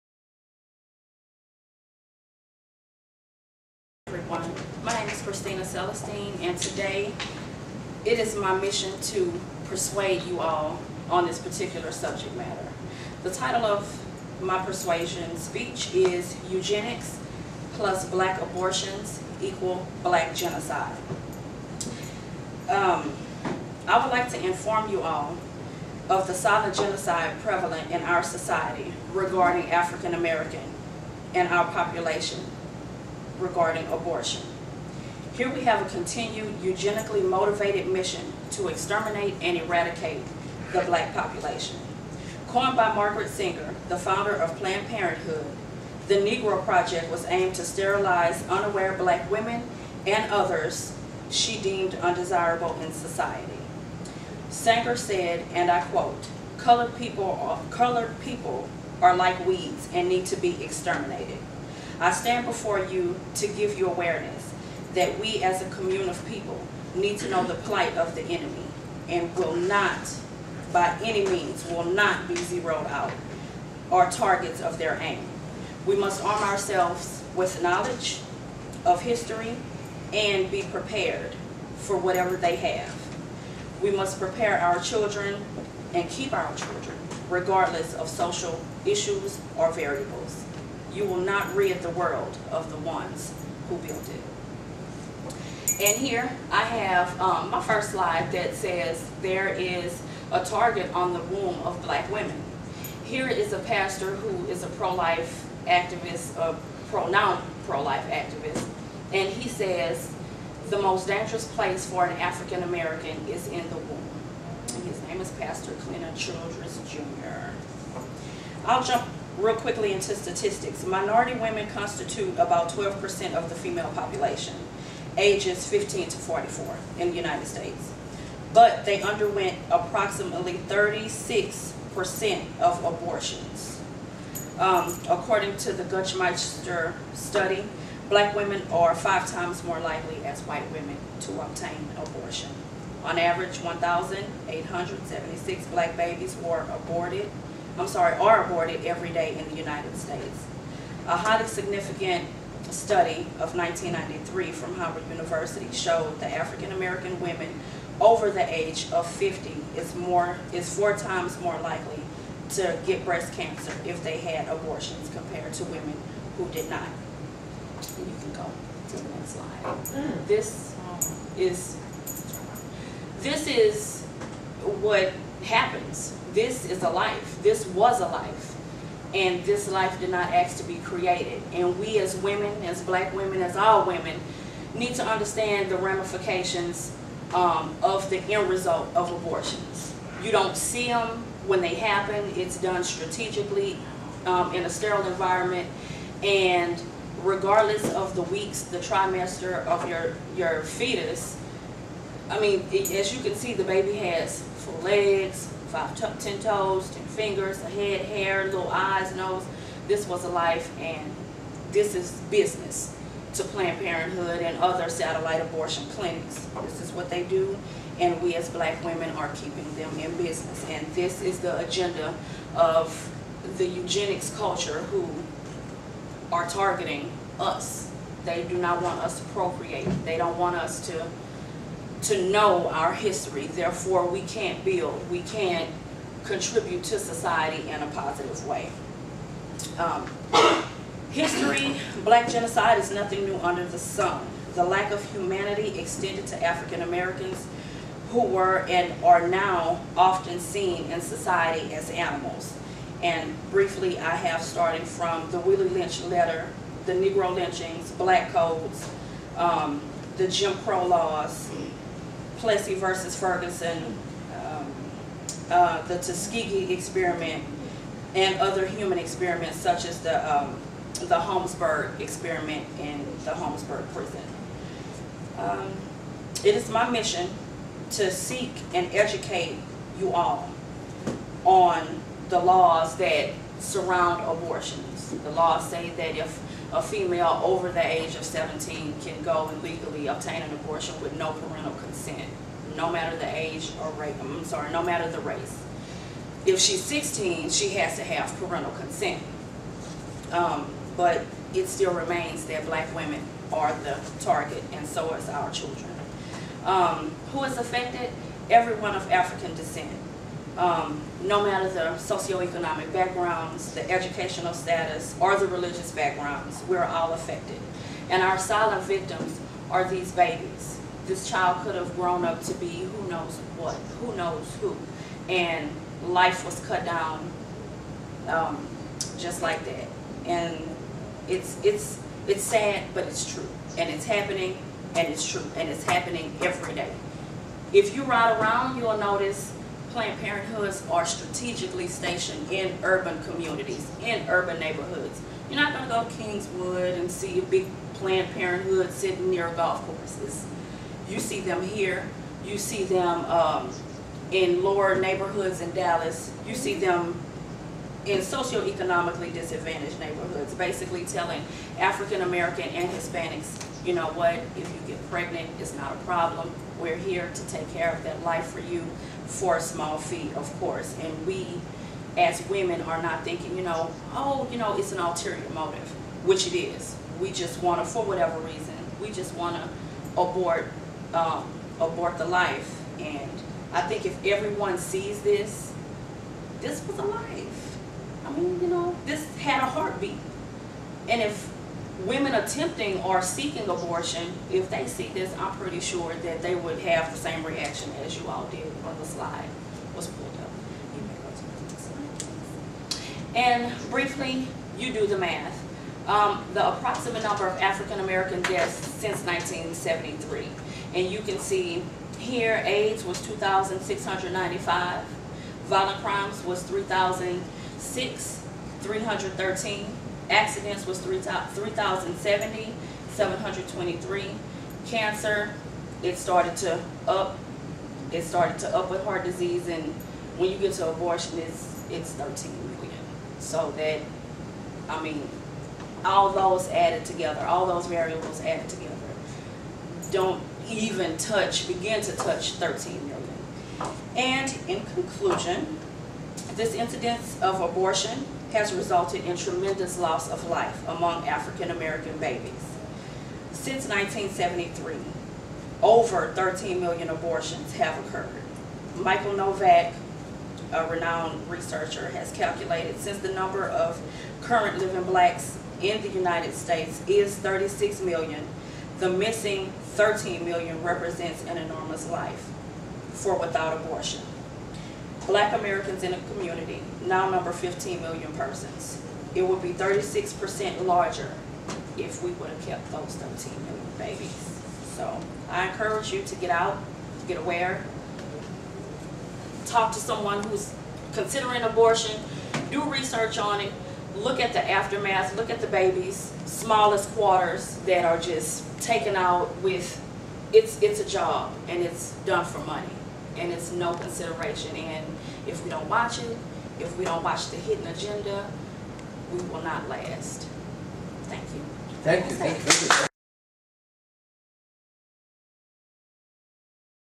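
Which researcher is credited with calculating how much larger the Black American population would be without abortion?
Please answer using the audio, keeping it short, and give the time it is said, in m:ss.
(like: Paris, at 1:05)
Michael Novak, at 7:38.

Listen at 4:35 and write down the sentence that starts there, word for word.
Um, it is my mission to seek and educate you all on the laws that surround abortions.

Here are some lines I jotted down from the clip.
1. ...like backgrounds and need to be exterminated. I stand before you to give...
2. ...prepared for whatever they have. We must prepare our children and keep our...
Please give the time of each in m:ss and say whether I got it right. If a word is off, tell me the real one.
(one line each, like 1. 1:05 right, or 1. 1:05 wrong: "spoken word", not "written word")
1. 0:59 wrong: "weeds", not "backgrounds"
2. 1:20 right.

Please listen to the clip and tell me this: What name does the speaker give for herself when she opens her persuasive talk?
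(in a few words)
Christina Celestine.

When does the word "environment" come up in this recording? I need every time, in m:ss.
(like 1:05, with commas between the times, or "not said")
3:15.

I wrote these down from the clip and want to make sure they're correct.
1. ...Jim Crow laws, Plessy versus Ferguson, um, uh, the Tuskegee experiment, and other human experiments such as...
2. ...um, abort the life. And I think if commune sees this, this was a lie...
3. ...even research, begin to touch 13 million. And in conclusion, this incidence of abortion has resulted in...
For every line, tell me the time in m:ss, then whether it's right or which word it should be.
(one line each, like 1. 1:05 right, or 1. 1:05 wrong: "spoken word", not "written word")
1. 4:20 right
2. 6:21 wrong: "everyone", not "commune"
3. 7:20 wrong: "touch", not "research".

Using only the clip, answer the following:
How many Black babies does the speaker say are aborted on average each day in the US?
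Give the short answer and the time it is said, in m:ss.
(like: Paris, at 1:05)
1,876, at 2:23.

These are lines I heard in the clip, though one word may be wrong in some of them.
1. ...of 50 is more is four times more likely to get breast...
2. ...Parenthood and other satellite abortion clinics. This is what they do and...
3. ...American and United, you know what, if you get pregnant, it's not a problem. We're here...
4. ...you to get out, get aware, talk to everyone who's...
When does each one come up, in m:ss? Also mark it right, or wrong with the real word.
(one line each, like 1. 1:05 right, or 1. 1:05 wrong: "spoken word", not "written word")
1. 2:38 right
2. 3:33 right
3. 6:02 wrong: "Hispanics", not "United"
4. 8:06 wrong: "someone", not "everyone".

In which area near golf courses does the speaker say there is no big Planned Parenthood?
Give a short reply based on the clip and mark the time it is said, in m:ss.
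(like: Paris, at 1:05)
Kingwood, at 5:46.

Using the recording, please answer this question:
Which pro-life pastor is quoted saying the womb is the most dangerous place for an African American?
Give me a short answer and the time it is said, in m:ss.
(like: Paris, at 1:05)
Clinton Childress Jr., at 1:55.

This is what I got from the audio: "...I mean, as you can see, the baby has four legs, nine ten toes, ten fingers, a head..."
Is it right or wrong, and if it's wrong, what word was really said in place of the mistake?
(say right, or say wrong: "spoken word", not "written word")
wrong: "five", not "nine".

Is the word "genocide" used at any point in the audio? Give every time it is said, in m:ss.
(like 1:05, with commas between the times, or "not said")
0:20, 0:26, 4:02.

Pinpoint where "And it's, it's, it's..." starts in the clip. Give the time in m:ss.
5:30.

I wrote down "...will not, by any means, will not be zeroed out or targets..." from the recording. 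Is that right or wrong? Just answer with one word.
right.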